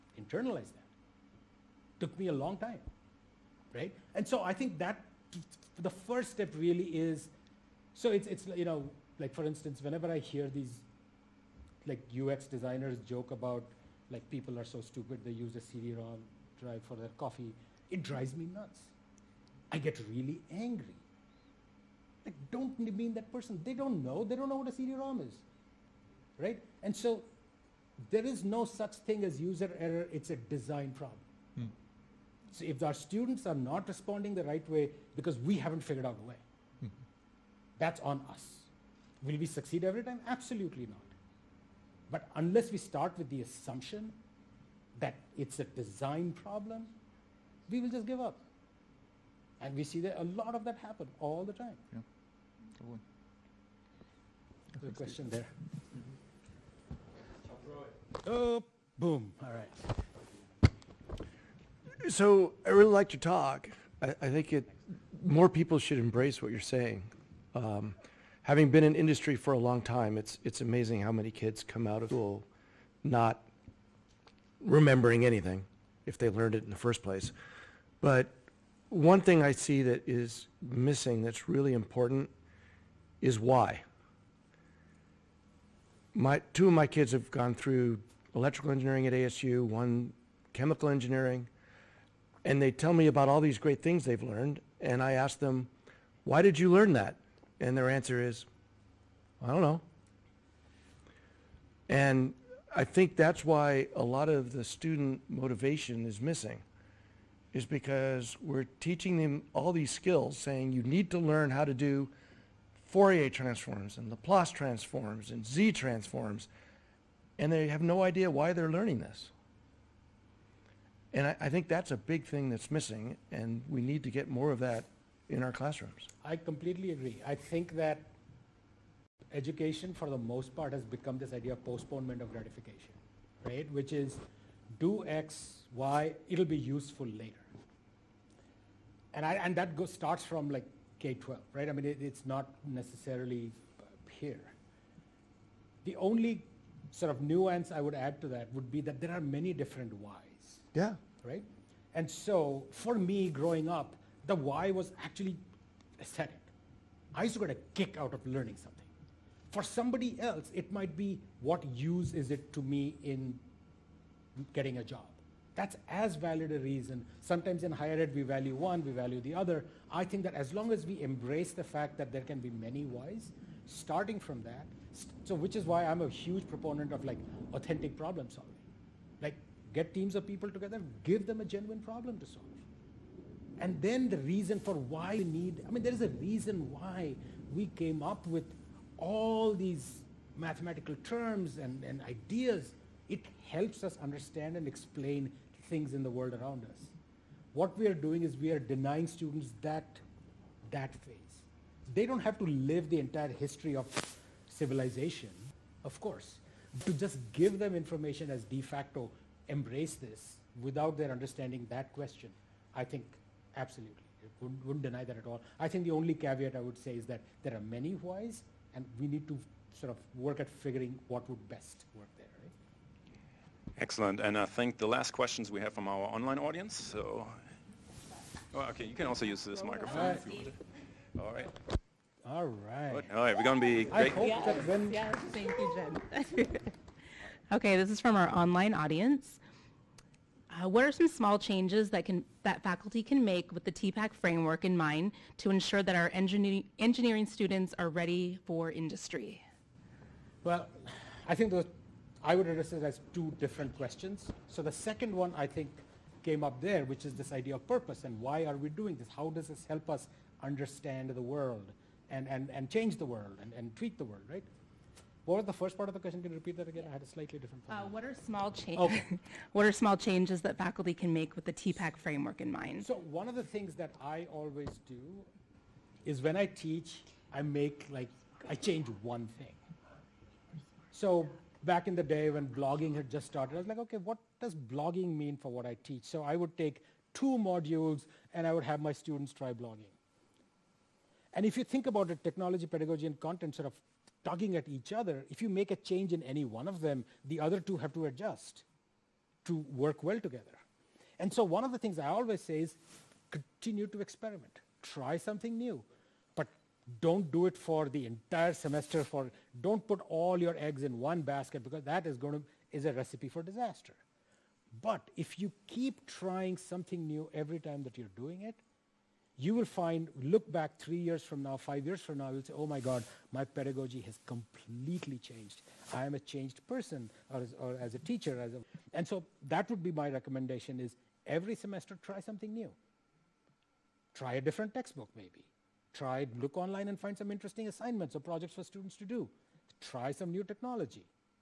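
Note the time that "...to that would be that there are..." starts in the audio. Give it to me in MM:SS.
02:28.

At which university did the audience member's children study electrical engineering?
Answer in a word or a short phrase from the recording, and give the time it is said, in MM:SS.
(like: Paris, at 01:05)
ASU, at 01:29.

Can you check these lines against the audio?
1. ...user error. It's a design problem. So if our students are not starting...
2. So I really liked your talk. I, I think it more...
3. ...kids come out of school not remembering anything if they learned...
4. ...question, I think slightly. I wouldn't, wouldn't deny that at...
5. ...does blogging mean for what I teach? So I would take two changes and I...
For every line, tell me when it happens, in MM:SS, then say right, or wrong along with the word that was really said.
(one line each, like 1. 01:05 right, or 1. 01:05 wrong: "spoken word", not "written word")
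1. 00:29 wrong: "responding", not "starting"
2. 01:02 right
3. 01:11 right
4. 03:31 wrong: "absolutely", not "slightly"
5. 04:44 wrong: "modules", not "changes".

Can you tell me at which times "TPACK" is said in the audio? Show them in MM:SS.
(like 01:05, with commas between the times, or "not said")
04:03, 04:31.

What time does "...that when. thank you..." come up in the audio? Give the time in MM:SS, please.
03:54.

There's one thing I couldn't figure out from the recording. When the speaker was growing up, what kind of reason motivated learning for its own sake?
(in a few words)
Aesthetic.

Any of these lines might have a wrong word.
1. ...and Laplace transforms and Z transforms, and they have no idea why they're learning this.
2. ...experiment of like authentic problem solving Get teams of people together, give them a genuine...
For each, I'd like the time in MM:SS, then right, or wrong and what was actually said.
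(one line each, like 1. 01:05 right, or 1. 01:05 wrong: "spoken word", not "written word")
1. 01:53 right
2. 02:56 wrong: "proponent", not "experiment".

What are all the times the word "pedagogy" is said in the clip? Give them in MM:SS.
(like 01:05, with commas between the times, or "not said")
04:52, 05:23.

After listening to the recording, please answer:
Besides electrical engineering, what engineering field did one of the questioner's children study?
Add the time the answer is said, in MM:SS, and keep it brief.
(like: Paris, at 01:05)
Chemical engineering, at 01:30.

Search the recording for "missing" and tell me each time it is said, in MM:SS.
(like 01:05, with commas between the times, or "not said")
01:20, 01:46, 02:02.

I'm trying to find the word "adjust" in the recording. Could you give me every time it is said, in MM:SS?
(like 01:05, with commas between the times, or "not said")
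04:58.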